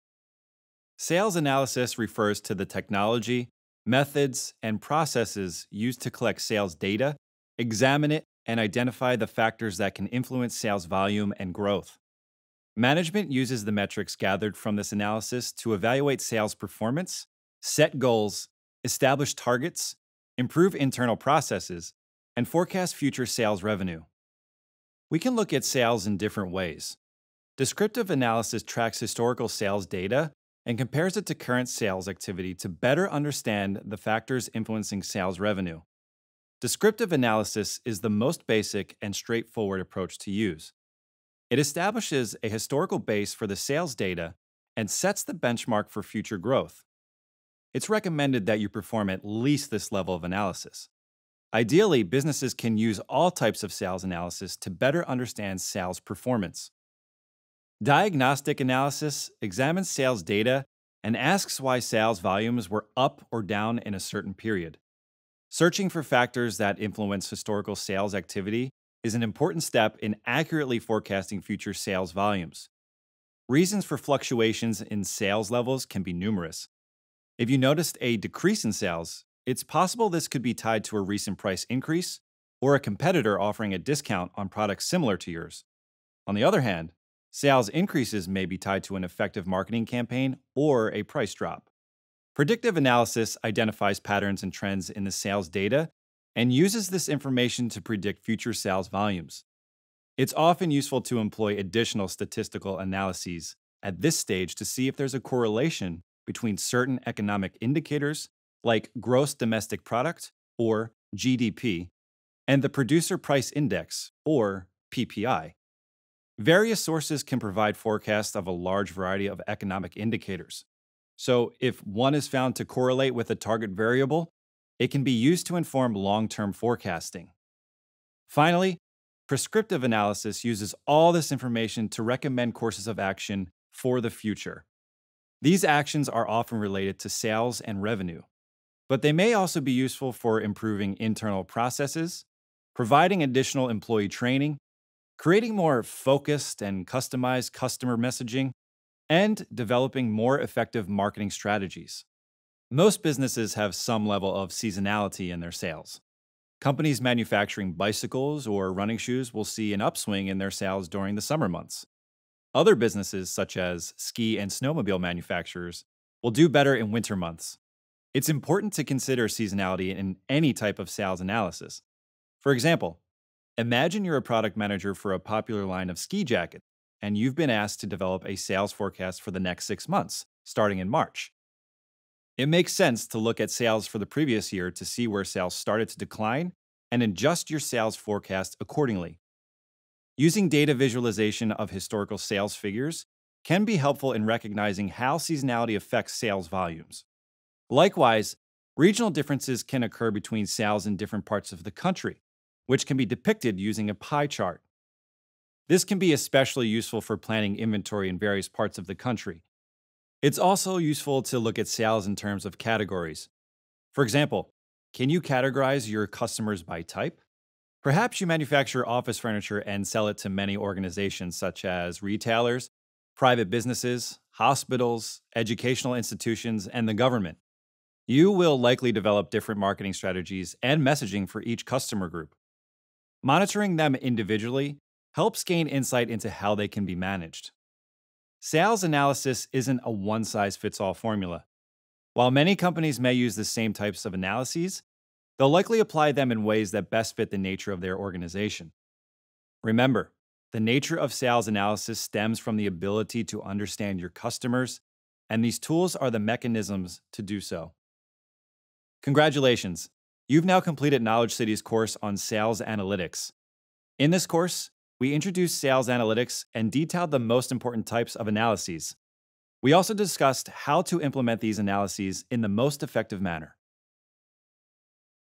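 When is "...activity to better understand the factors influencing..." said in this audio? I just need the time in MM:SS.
00:32.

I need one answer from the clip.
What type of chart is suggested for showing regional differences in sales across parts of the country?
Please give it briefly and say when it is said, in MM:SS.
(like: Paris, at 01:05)
Pie chart, at 03:23.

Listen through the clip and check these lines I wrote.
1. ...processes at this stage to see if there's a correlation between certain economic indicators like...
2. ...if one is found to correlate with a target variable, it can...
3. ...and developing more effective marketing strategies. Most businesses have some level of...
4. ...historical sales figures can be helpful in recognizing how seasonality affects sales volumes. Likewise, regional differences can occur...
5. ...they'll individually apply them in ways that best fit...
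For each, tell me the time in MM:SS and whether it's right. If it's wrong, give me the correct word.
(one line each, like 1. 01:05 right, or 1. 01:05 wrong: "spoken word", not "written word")
1. 01:42 wrong: "analyses", not "processes"
2. 02:01 right
3. 02:29 right
4. 03:11 right
5. 04:05 wrong: "likely", not "individually".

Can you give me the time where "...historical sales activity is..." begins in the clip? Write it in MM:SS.
01:07.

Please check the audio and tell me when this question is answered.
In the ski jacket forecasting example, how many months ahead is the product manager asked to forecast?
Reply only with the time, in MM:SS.
02:59.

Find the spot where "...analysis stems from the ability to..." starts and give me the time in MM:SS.
04:11.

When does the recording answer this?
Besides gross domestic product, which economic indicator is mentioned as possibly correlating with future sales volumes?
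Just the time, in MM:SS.
01:52.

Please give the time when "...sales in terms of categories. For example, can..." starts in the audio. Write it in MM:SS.
03:31.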